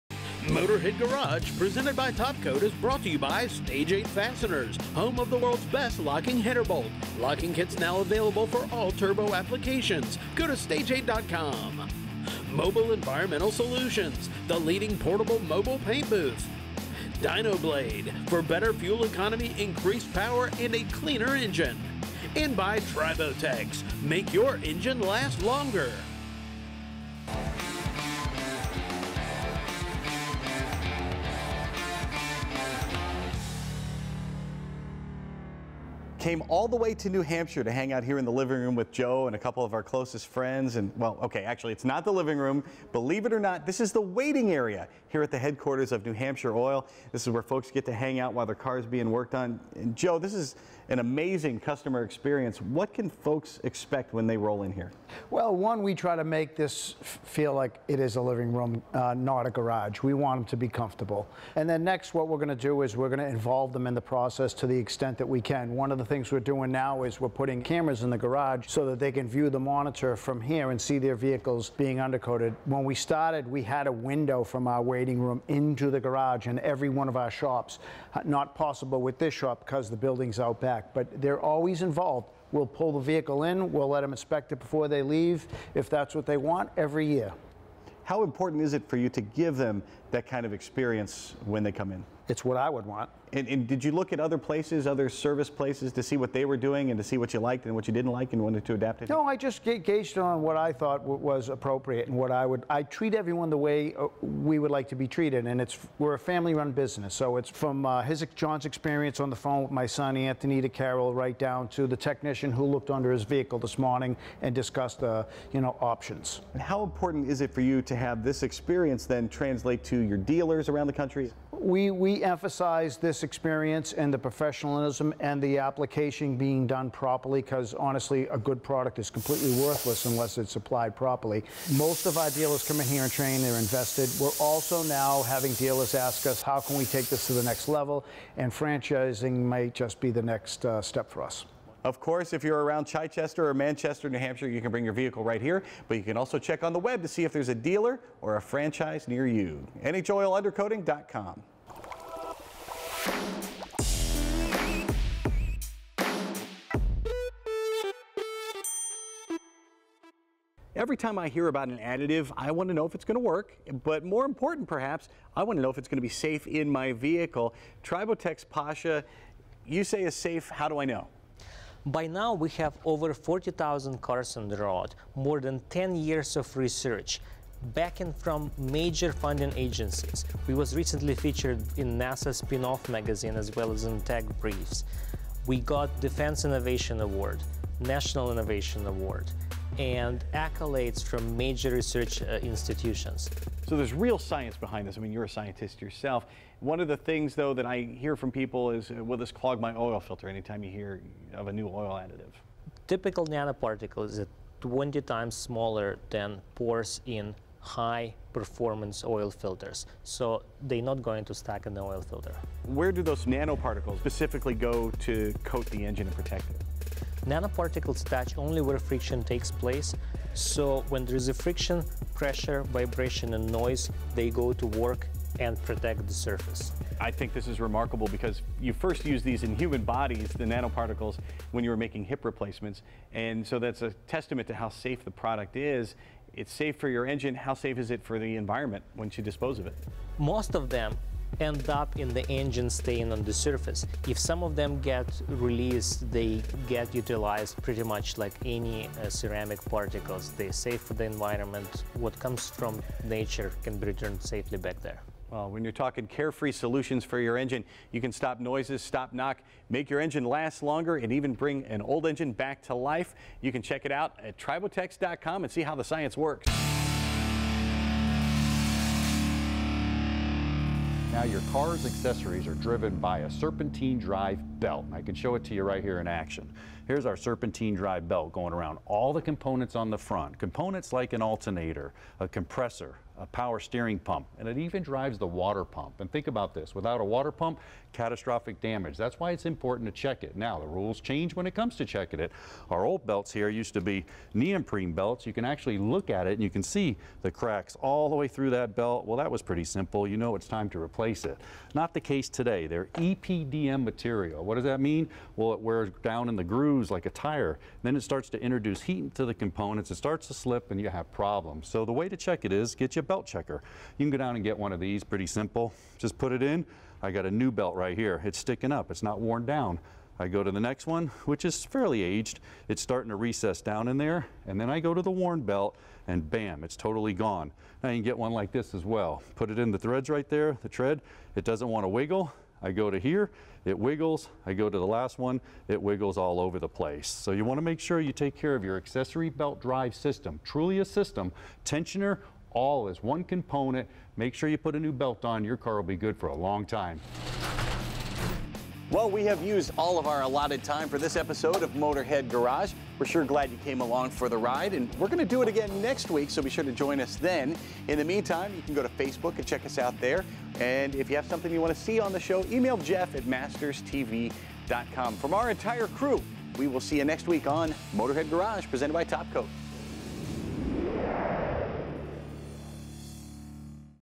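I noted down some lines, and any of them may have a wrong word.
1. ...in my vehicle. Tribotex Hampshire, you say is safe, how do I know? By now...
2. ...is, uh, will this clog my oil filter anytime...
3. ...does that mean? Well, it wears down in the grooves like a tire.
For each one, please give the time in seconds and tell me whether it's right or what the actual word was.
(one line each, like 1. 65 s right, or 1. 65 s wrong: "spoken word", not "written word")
1. 166 s wrong: "Pasha", not "Hampshire"
2. 198 s right
3. 304 s right.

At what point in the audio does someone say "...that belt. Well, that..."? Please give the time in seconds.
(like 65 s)
298 s.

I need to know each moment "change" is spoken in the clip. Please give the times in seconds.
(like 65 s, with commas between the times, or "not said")
291 s.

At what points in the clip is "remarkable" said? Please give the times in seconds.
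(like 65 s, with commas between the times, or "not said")
227 s.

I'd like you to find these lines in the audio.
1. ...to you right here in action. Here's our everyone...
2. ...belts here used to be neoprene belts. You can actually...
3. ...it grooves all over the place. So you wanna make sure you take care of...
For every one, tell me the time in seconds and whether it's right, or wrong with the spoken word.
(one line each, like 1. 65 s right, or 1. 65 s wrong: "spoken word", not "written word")
1. 275 s wrong: "serpentine", not "everyone"
2. 293 s right
3. 335 s wrong: "wiggles", not "grooves".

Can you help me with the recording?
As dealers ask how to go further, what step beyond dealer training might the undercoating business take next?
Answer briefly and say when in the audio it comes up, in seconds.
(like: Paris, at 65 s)
franchising, at 138 s.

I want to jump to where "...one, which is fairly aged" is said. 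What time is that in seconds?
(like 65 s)
320 s.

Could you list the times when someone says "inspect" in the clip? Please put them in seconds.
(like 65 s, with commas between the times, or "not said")
84 s.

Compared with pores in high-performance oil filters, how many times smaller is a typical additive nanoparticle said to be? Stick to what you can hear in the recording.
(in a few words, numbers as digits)
20.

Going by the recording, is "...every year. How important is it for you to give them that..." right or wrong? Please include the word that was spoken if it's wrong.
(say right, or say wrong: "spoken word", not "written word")
right.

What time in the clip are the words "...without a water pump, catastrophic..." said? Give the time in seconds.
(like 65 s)
286 s.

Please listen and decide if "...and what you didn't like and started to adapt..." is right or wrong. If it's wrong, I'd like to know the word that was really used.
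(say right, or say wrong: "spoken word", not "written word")
wrong: "wanted", not "started".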